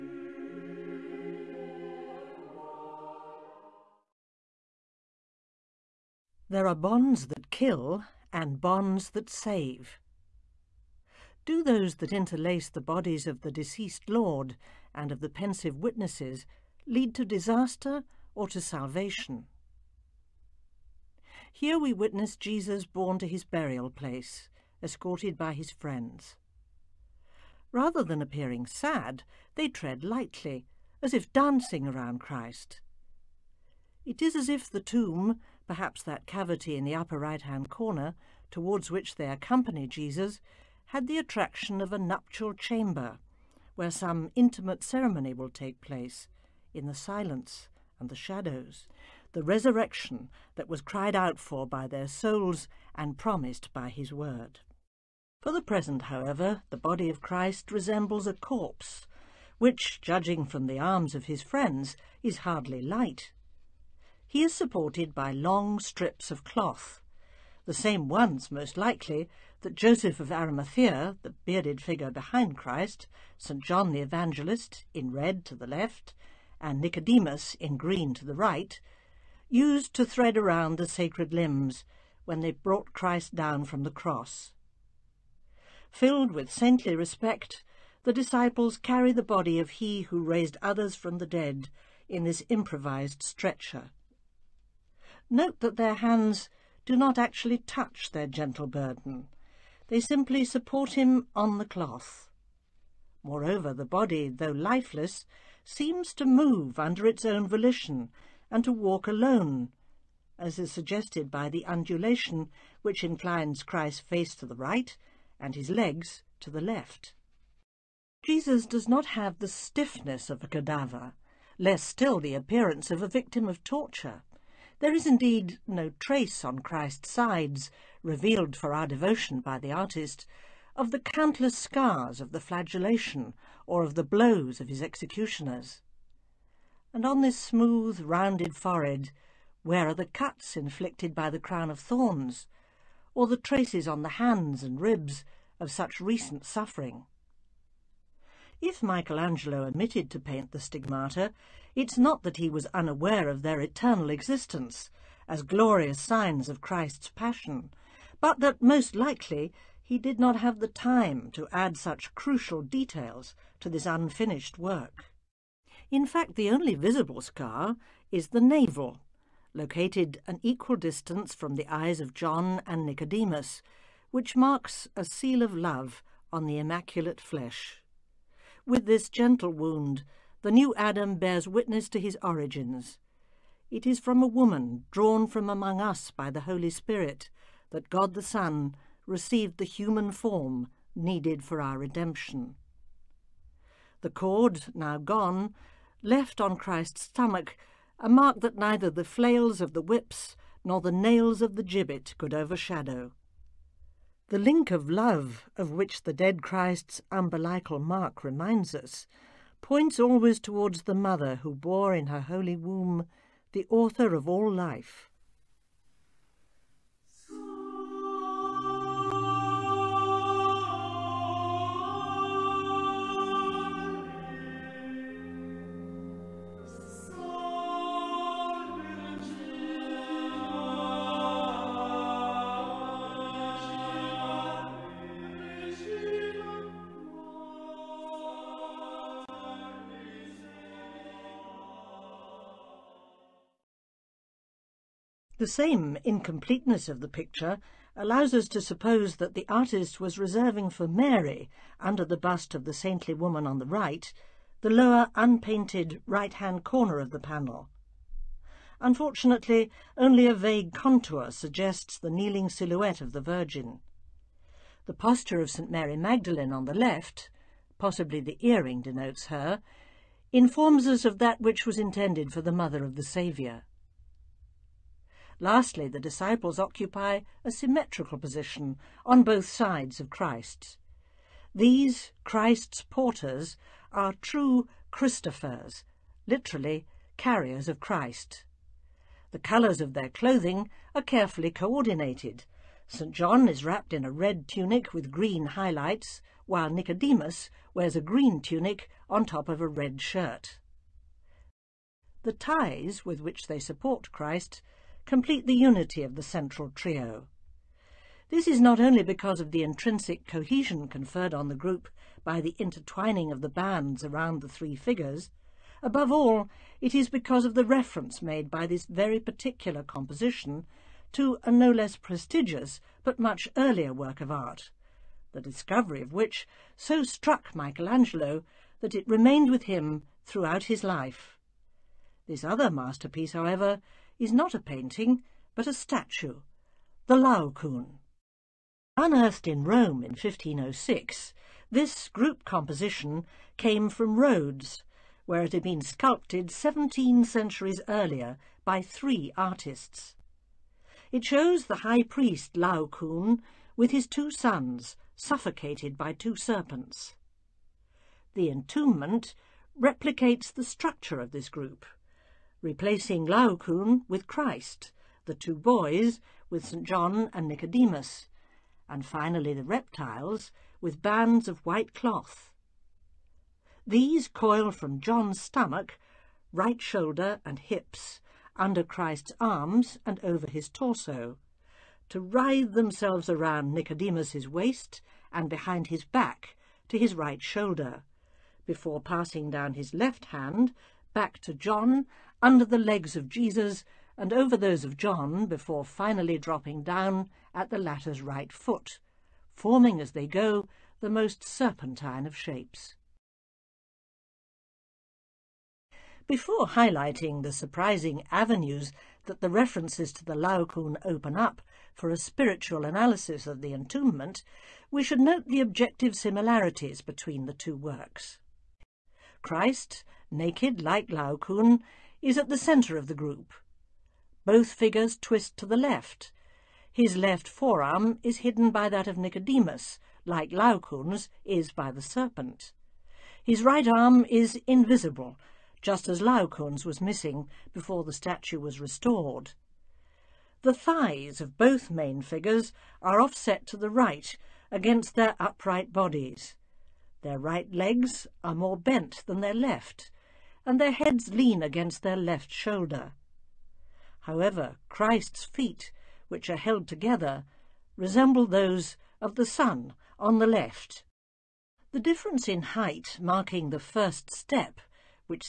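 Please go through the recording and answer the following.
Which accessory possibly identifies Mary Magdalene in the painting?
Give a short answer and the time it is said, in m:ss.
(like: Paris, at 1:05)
The earring, at 4:28.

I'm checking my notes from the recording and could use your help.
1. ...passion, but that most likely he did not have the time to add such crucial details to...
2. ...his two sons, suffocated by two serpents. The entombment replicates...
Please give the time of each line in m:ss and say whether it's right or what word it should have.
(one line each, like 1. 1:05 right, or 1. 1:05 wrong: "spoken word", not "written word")
1. 2:37 right
2. 5:53 right.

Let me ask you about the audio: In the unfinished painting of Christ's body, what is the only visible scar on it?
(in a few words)
The navel.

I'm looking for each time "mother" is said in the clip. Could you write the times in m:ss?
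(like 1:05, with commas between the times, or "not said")
3:30, 4:32.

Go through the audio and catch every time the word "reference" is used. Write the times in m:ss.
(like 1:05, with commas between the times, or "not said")
5:17, 6:49.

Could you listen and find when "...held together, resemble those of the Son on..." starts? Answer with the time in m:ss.
7:36.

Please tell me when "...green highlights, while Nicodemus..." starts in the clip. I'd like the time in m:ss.
4:55.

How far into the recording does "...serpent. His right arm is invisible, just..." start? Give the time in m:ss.
7:12.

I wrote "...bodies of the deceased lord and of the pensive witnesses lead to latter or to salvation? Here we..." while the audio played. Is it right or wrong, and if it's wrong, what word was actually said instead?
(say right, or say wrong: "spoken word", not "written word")
wrong: "disaster", not "latter".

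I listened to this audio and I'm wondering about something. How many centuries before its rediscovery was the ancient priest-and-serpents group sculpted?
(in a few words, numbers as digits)
17.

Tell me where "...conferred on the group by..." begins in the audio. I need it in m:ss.
5:10.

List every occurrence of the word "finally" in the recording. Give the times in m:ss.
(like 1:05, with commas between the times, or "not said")
6:09, 6:35.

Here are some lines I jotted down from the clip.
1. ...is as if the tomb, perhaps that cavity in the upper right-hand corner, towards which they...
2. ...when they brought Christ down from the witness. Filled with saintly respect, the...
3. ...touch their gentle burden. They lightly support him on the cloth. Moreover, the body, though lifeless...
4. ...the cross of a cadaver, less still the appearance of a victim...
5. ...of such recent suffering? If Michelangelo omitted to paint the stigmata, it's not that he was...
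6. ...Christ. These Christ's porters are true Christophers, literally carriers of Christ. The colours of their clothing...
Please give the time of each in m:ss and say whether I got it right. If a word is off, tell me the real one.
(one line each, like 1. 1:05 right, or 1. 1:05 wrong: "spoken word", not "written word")
1. 0:34 right
2. 1:22 wrong: "cross", not "witness"
3. 1:37 wrong: "simply", not "lightly"
4. 1:59 wrong: "stiffness", not "cross"
5. 2:25 right
6. 4:40 right.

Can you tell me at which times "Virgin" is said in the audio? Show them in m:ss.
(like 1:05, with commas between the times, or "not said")
4:23.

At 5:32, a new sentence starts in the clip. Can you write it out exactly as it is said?
This other masterpiece, however, is not a painting, but a statue, the Laocoon.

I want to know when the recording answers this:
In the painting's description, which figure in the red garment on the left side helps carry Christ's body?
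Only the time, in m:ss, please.
1:13.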